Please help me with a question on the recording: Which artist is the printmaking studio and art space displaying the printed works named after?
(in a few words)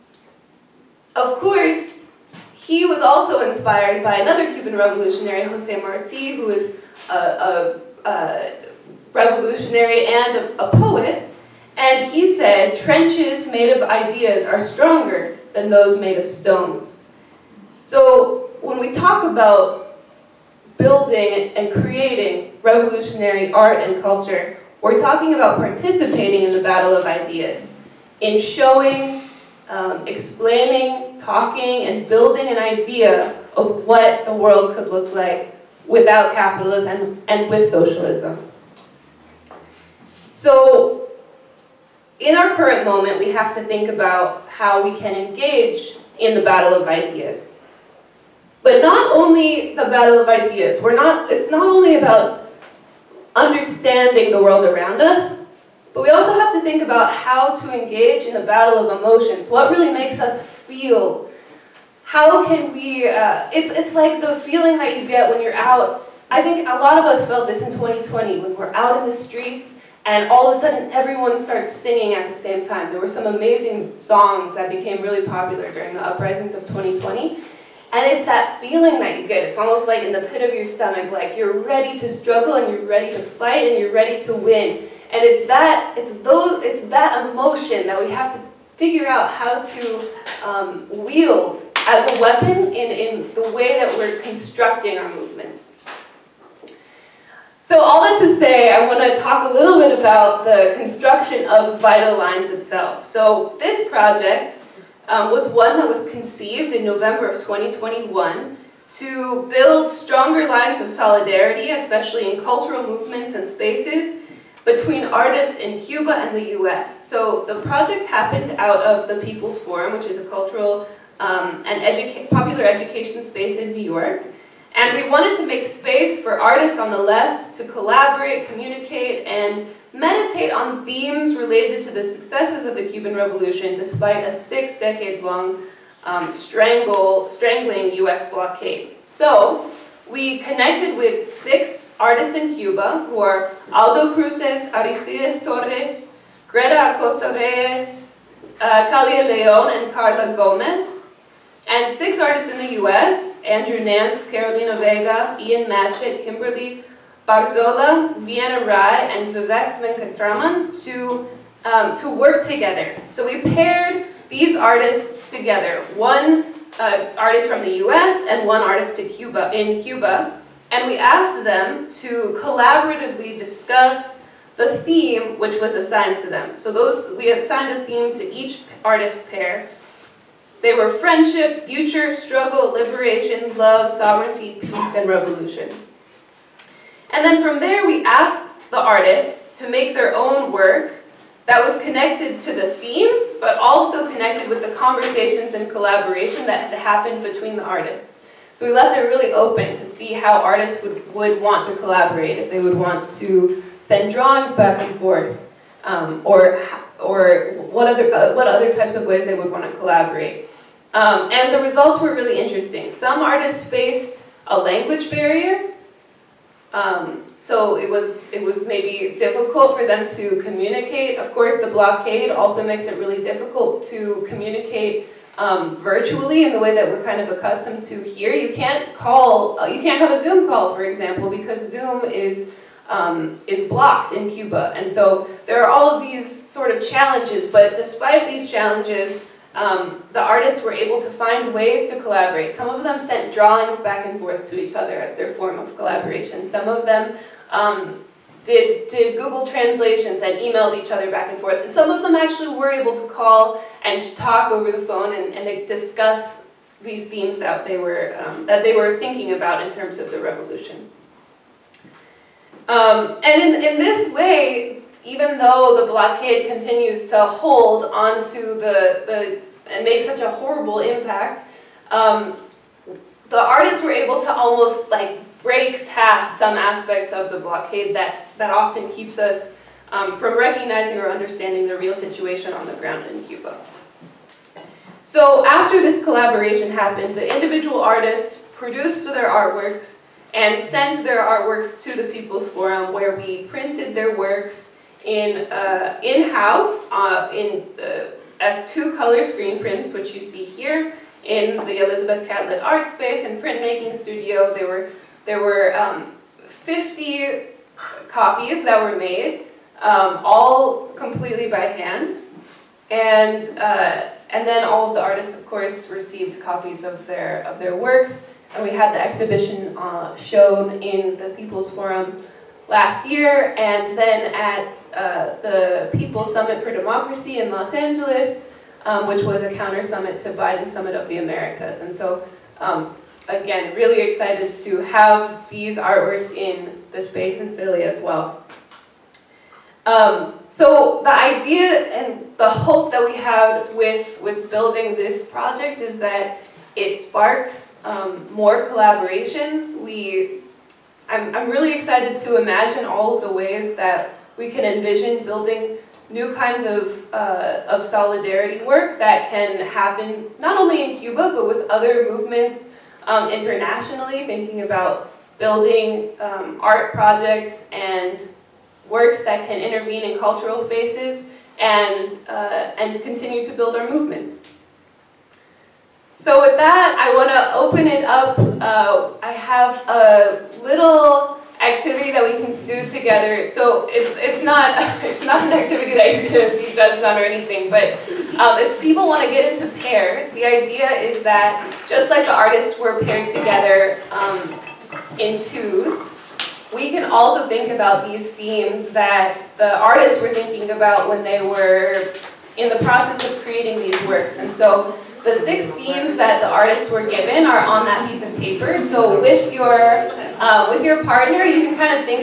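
Elizabeth Catlett.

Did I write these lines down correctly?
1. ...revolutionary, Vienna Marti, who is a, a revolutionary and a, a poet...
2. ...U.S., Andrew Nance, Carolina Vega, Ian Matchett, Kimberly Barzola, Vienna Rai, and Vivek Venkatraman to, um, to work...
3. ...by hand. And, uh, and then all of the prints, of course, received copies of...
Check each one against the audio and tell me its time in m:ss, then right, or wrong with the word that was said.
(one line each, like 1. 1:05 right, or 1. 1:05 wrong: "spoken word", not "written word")
1. 0:04 wrong: "Jose", not "Vienna"
2. 2:32 right
3. 5:11 wrong: "artists", not "prints".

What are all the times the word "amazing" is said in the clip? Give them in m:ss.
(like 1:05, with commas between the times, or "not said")
1:13.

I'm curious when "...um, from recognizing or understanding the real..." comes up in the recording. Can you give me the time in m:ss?
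4:39.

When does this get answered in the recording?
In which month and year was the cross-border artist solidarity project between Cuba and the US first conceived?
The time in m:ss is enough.
1:46.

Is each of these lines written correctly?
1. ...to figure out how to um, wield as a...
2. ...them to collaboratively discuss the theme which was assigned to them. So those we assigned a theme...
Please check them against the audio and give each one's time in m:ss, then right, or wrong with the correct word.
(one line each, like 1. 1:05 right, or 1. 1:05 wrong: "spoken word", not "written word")
1. 1:28 right
2. 2:51 right.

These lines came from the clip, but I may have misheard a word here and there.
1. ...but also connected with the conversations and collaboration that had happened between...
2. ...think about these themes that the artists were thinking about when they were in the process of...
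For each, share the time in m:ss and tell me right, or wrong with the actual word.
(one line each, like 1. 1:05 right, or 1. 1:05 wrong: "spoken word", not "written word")
1. 3:13 right
2. 6:37 right.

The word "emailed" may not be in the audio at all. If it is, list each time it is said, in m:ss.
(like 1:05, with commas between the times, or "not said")
4:10.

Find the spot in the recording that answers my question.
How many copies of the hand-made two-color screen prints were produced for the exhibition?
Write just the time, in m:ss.
5:06.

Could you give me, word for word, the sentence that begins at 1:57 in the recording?
So the project happened out of the People's Forum, which is a cultural um, an educa popular education space in New York.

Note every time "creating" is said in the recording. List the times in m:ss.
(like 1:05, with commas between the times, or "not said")
0:21, 6:43.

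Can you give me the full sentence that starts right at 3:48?
You can't call, uh, you can't have a Zoom call, for example, because Zoom is um, is blocked in Cuba.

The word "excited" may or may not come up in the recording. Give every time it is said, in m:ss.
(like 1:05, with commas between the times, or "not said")
5:34, 5:51.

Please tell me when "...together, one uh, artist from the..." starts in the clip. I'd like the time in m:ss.
2:45.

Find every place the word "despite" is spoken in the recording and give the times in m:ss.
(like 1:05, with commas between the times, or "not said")
2:13, 3:57.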